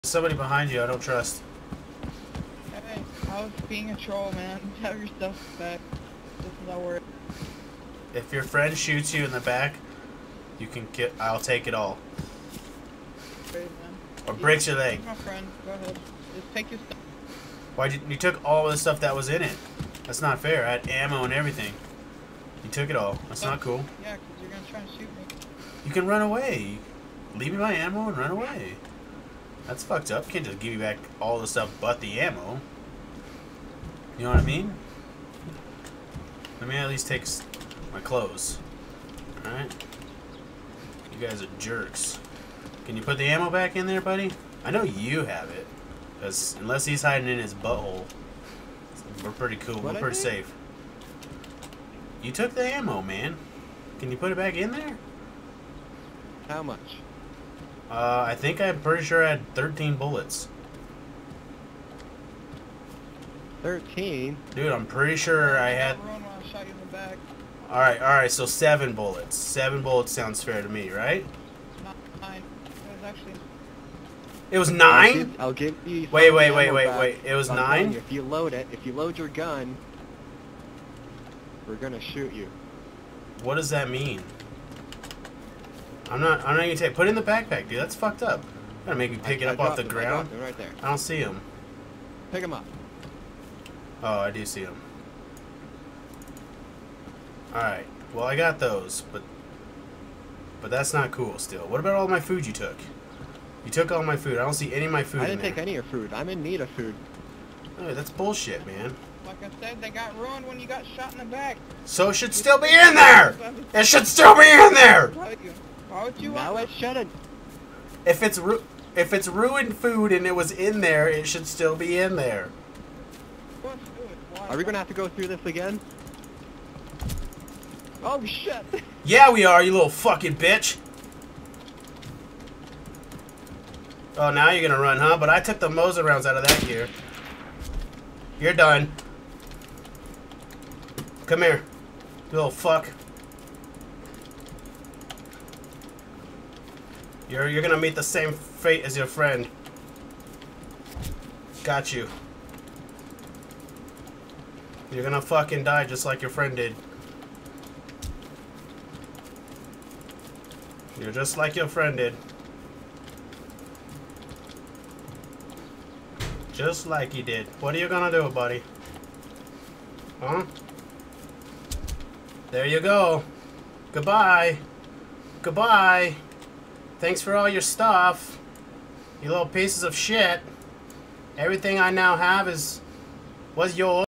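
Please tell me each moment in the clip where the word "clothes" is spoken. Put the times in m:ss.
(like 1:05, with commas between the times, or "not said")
0:37.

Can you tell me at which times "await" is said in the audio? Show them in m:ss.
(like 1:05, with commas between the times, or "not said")
not said.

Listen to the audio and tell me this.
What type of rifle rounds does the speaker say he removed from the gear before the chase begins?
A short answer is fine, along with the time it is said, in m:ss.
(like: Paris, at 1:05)
Mosin rounds, at 2:15.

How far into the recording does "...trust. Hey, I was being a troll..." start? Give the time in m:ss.
0:00.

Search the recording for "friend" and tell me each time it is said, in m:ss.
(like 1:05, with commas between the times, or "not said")
0:08, 0:15, 2:29, 2:36, 2:41.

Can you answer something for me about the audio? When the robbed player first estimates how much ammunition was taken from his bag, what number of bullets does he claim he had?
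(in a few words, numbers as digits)
13.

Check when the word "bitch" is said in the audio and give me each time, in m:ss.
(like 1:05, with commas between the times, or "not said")
2:10.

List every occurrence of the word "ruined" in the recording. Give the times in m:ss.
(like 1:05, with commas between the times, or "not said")
1:50, 1:59.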